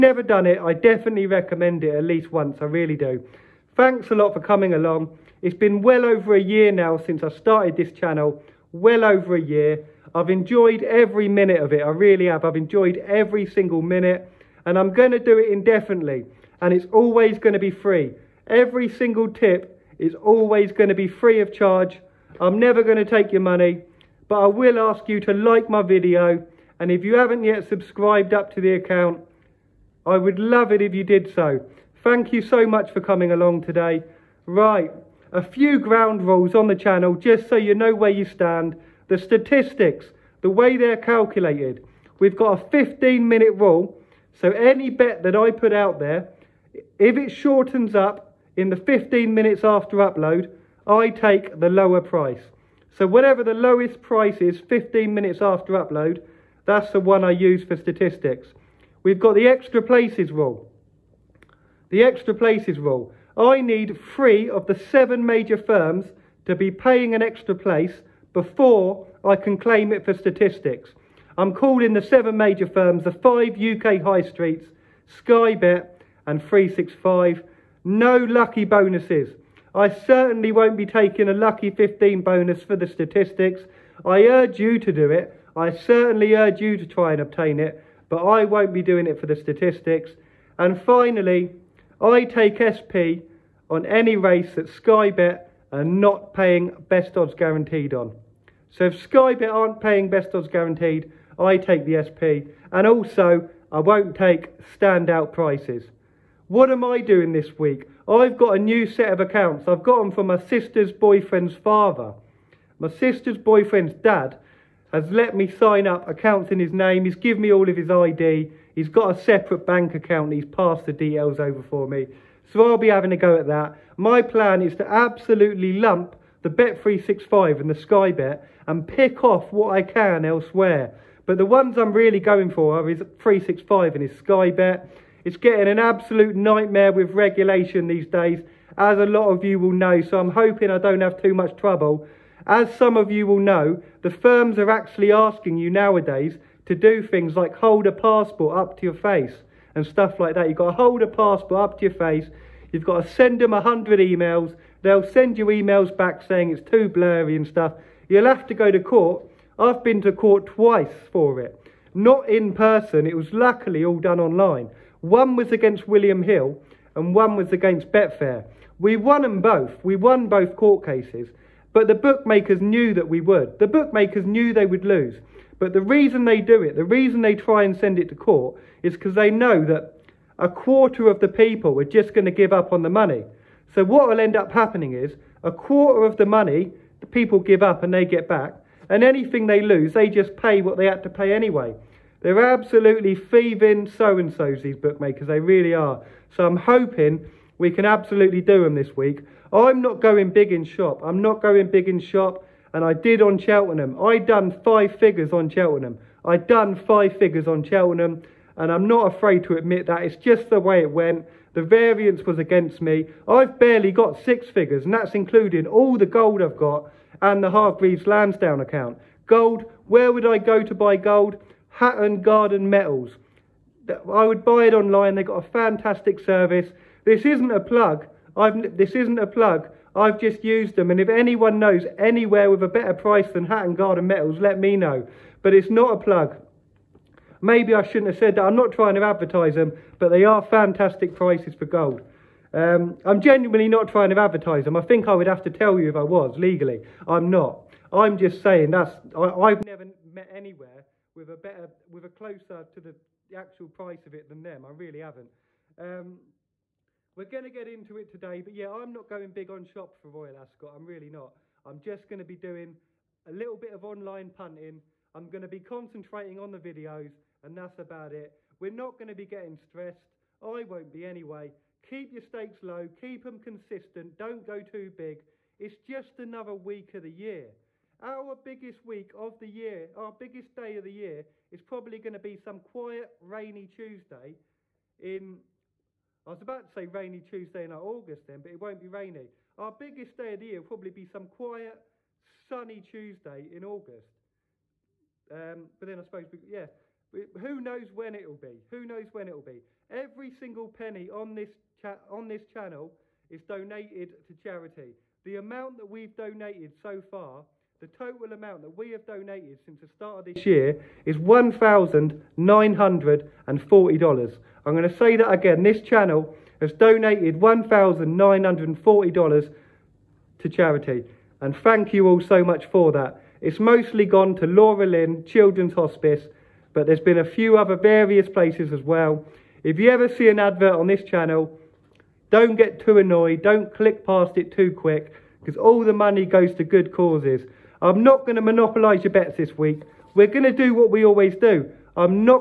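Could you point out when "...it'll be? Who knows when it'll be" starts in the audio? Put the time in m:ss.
4:58.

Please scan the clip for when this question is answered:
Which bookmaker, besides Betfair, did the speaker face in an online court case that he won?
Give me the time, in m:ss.
2:45.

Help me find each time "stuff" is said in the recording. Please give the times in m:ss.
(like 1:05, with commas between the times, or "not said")
2:29, 2:37.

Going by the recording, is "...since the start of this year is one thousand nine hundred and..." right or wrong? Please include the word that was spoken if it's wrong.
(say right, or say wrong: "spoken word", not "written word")
right.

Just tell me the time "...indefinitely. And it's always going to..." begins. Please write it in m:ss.
0:15.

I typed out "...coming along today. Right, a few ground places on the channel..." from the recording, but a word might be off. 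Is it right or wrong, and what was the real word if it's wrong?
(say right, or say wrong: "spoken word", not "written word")
wrong: "rules", not "places".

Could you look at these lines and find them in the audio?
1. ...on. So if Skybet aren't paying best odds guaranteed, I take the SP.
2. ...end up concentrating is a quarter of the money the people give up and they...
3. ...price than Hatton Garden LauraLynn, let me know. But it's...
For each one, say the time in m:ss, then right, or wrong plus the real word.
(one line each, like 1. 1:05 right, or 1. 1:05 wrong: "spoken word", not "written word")
1. 1:37 right
2. 3:04 wrong: "happening", not "concentrating"
3. 3:52 wrong: "Metals", not "LauraLynn".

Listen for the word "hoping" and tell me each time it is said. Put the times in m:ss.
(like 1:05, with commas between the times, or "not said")
2:20, 3:16.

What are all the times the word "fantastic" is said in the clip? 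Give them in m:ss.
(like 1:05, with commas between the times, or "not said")
3:45, 4:00.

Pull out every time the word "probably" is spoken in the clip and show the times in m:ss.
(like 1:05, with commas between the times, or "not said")
4:41, 4:50.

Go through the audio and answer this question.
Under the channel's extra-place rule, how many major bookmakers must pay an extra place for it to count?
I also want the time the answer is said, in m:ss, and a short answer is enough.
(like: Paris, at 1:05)
3, at 1:04.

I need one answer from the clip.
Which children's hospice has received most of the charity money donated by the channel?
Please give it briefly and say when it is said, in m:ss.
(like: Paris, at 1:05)
LauraLynn Children's Hospice, at 5:24.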